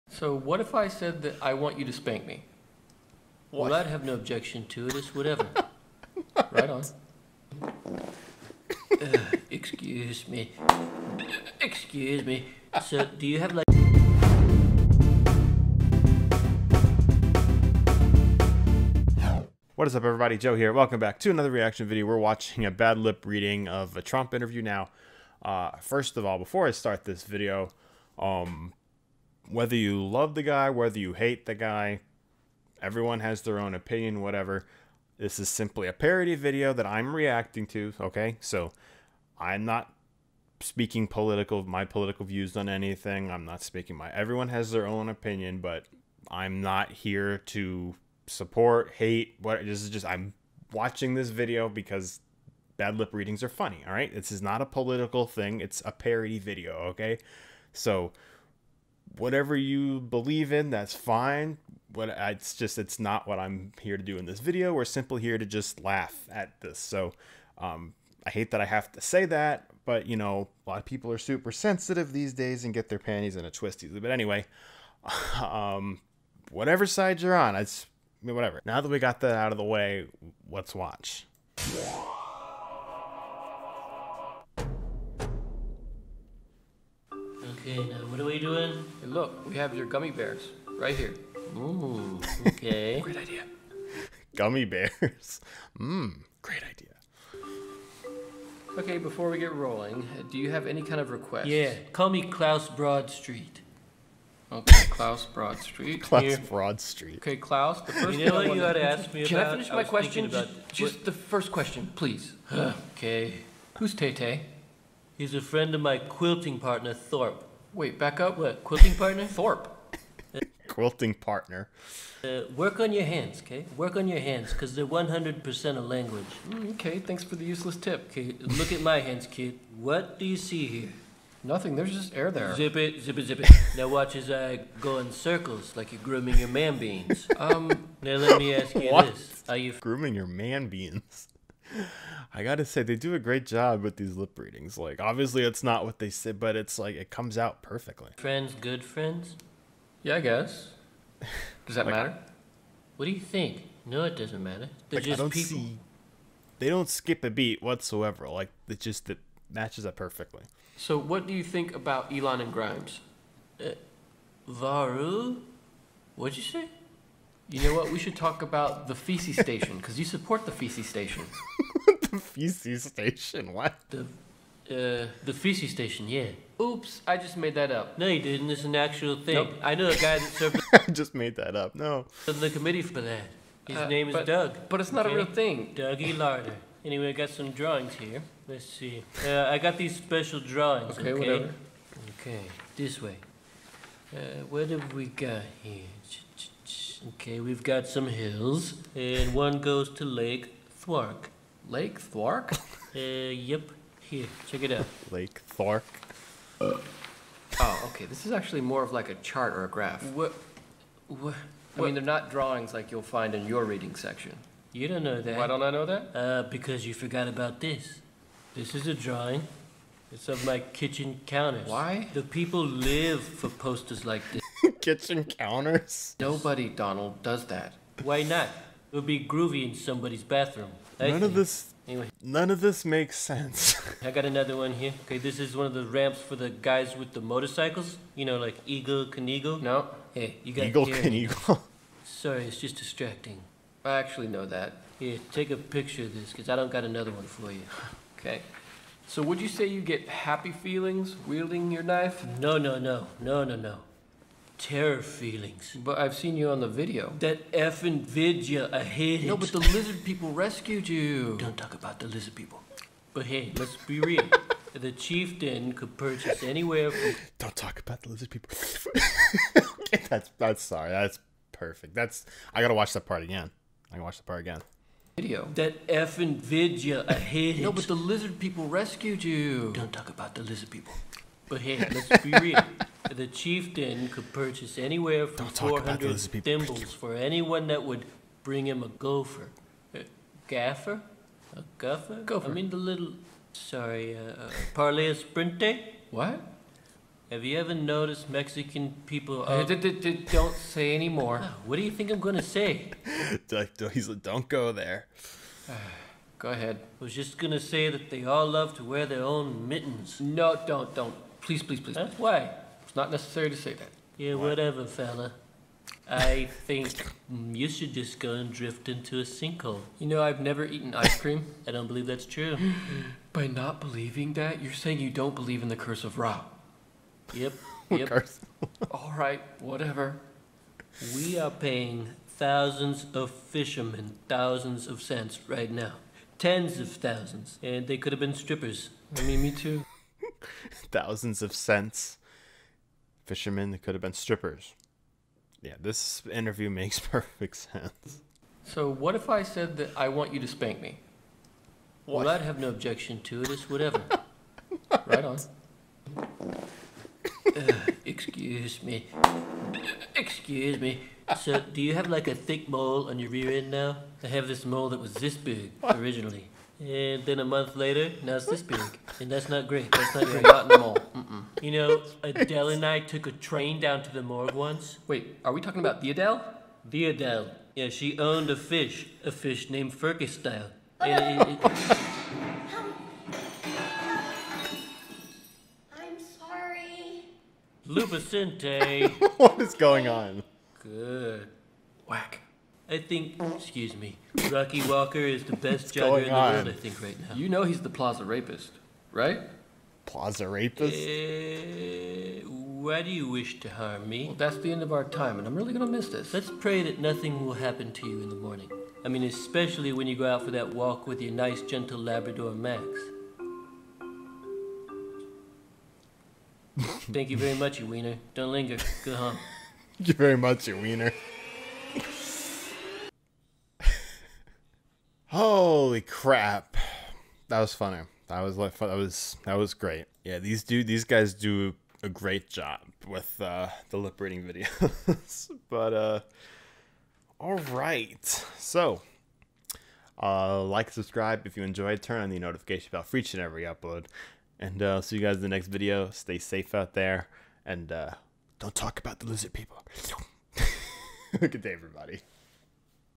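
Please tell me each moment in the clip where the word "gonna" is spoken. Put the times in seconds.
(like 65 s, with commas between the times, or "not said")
302 s, 307 s, 405 s.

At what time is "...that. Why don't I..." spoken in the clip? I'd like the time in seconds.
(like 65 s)
215 s.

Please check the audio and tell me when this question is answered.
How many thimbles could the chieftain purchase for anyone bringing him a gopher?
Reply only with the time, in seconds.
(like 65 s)
285 s.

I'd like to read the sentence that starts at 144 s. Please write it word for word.
Like obviously it's not what they said, but it's like it comes out perfectly.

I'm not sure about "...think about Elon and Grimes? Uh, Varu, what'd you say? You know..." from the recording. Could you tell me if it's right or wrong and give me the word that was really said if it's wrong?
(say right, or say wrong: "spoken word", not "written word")
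right.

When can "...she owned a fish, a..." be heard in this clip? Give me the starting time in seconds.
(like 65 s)
377 s.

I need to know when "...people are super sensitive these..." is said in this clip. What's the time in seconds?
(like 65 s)
70 s.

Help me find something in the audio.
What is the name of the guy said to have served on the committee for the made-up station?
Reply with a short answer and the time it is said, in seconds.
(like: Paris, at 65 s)
Dougie Larder, at 185 s.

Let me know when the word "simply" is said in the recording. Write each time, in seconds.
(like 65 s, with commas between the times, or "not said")
35 s, 64 s.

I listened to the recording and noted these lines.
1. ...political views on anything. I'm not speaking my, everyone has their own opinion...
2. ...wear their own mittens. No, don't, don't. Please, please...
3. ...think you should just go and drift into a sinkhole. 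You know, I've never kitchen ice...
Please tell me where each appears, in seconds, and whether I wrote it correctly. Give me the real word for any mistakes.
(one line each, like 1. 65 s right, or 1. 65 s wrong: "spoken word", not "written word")
1. 41 s right
2. 308 s right
3. 316 s wrong: "eaten", not "kitchen".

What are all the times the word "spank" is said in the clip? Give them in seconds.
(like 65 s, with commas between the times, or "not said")
1 s, 350 s.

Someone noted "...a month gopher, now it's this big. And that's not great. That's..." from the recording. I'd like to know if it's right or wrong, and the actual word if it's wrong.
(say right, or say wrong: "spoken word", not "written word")
wrong: "later", not "gopher".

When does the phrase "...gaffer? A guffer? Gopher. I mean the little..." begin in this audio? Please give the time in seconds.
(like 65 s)
290 s.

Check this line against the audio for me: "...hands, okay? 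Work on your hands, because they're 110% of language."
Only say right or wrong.
wrong.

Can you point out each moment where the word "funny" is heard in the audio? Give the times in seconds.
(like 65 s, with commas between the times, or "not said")
53 s, 427 s.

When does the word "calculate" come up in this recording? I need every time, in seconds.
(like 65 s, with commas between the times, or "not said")
not said.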